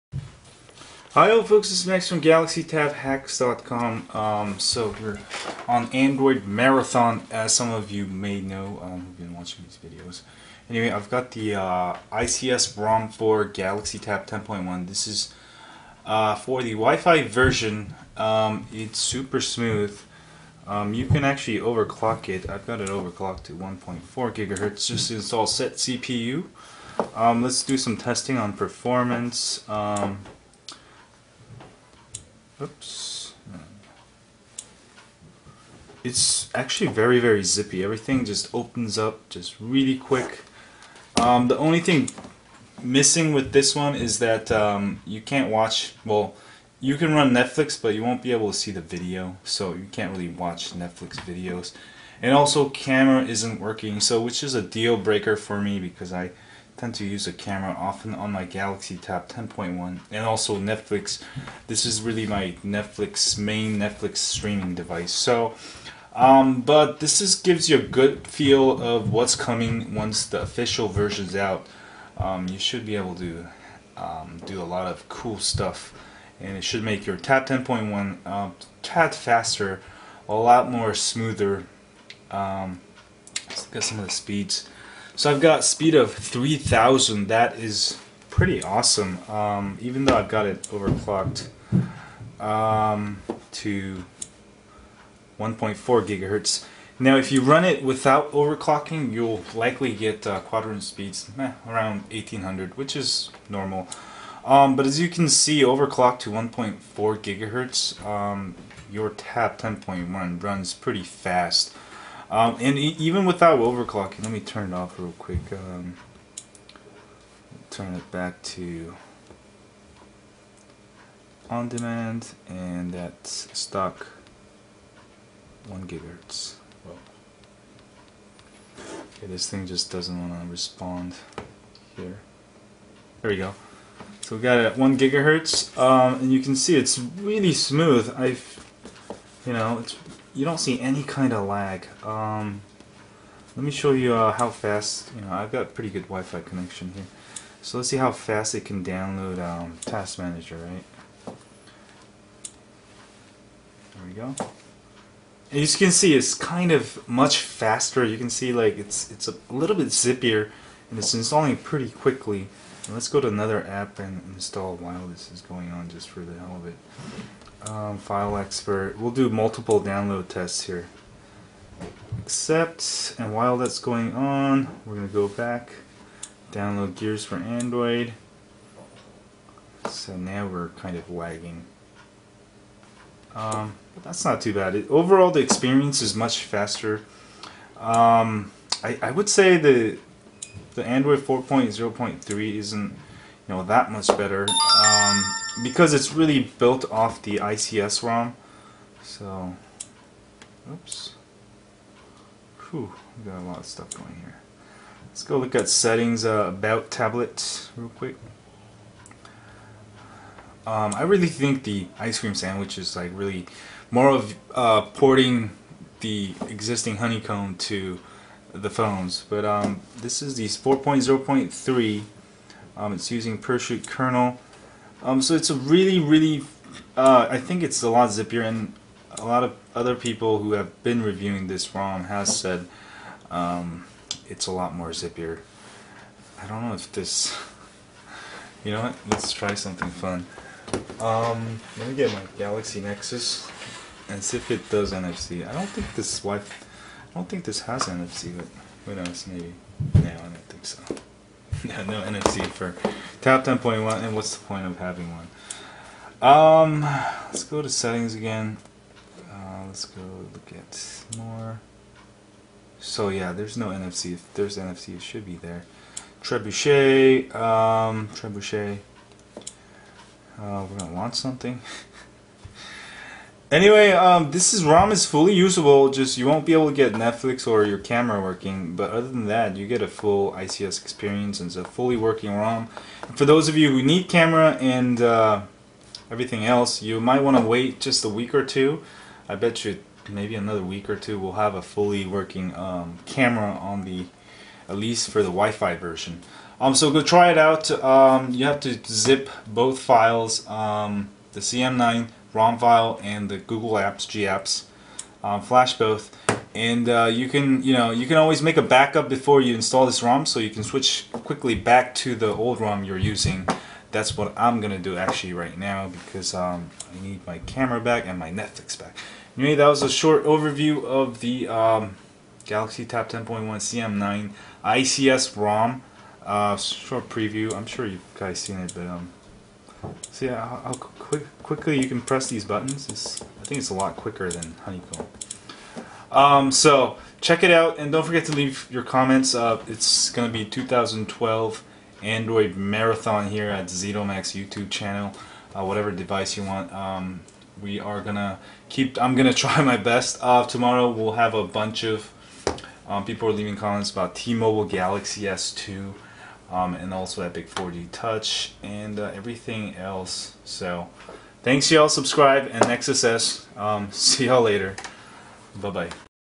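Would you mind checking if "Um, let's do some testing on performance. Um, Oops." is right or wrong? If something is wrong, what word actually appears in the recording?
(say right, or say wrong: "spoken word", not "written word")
right.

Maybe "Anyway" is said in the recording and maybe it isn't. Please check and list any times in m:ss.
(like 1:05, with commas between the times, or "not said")
0:10, 4:33, 5:19.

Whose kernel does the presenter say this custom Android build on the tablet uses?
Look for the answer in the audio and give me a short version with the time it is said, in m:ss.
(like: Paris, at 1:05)
Pershoot, at 3:43.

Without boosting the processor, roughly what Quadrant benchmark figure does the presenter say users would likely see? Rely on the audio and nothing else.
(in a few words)
1800.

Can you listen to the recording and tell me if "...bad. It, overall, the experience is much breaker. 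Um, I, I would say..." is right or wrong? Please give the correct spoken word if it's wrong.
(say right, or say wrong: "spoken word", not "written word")
wrong: "faster", not "breaker".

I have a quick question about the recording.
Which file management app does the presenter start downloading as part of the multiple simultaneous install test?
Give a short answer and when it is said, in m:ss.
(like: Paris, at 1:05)
File Expert, at 2:47.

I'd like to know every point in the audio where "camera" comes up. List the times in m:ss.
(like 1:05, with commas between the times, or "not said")
0:52, 0:57, 4:37, 4:44, 4:53, 5:17.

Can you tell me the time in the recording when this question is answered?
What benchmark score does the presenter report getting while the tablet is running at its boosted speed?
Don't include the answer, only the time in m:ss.
1:26.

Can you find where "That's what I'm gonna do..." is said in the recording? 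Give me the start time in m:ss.
5:13.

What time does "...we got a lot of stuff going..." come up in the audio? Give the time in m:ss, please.
3:23.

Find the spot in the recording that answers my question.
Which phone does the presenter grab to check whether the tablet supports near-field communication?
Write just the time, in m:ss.
4:02.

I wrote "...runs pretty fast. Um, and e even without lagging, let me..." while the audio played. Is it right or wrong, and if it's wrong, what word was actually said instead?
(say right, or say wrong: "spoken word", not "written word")
wrong: "overclocking", not "lagging".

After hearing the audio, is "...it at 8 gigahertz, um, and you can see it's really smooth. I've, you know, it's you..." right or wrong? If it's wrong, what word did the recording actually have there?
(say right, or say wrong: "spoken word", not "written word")
wrong: "1", not "8".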